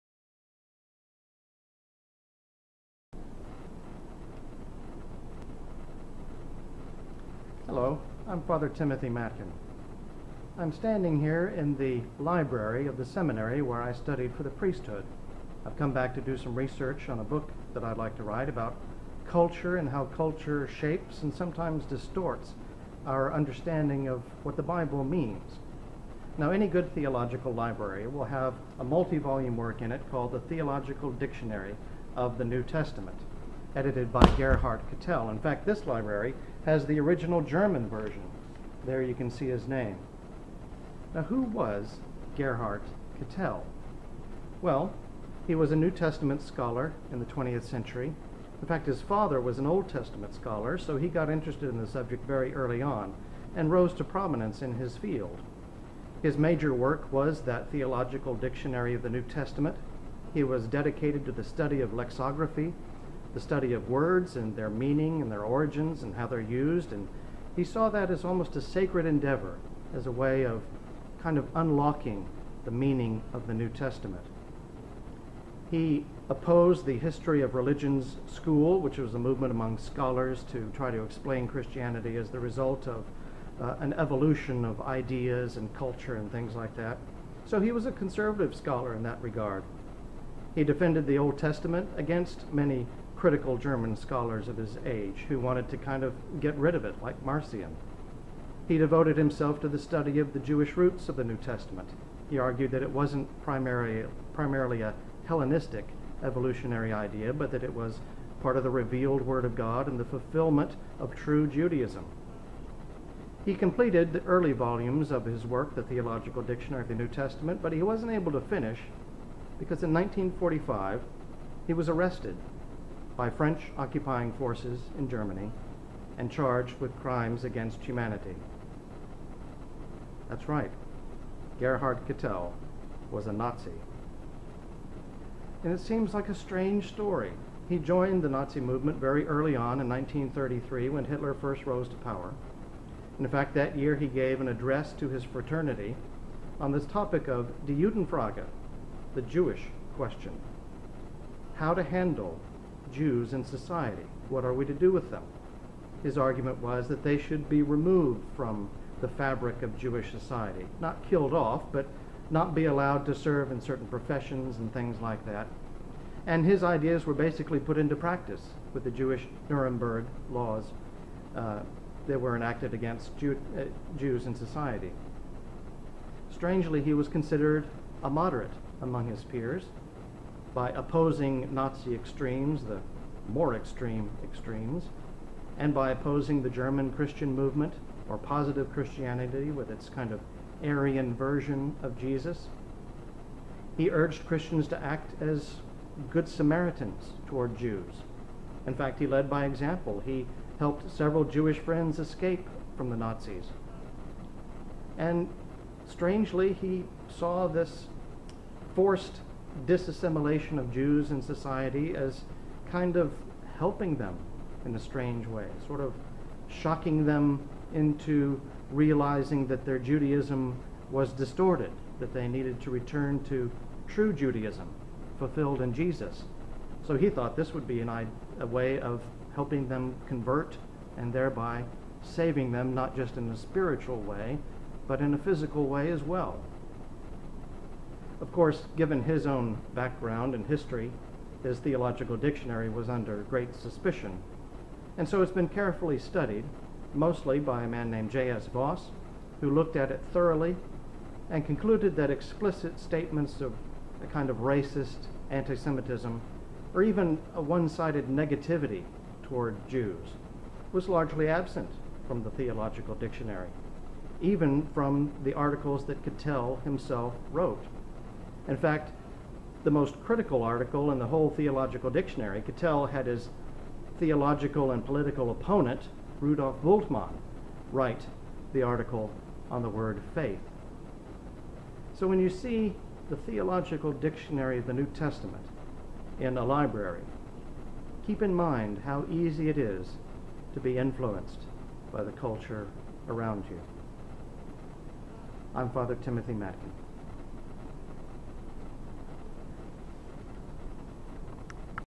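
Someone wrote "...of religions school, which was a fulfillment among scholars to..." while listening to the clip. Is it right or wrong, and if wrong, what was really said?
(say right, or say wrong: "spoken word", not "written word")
wrong: "movement", not "fulfillment".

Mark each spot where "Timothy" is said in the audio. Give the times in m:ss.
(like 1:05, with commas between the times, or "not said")
0:08, 4:55.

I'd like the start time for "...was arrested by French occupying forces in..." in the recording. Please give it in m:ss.
2:01.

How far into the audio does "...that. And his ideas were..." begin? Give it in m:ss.
2:45.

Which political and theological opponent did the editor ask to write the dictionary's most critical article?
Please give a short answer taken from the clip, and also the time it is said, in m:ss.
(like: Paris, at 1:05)
Rudolf Bultmann, at 4:36.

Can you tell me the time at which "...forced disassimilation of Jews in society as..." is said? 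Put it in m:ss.
3:28.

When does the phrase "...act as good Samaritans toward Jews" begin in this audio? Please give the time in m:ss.
3:14.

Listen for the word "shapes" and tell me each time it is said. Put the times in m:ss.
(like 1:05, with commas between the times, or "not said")
0:20.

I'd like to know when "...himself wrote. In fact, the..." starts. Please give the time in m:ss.
4:26.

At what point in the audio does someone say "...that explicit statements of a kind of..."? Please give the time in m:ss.
4:11.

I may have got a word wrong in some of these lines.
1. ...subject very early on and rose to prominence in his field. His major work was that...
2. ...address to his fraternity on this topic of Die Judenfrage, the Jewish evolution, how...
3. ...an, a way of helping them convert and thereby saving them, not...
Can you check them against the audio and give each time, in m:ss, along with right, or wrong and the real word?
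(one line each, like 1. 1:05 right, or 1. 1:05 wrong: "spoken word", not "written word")
1. 0:51 right
2. 2:24 wrong: "question", not "evolution"
3. 3:47 right.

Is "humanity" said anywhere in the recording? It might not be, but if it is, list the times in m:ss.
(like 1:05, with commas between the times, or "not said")
2:07.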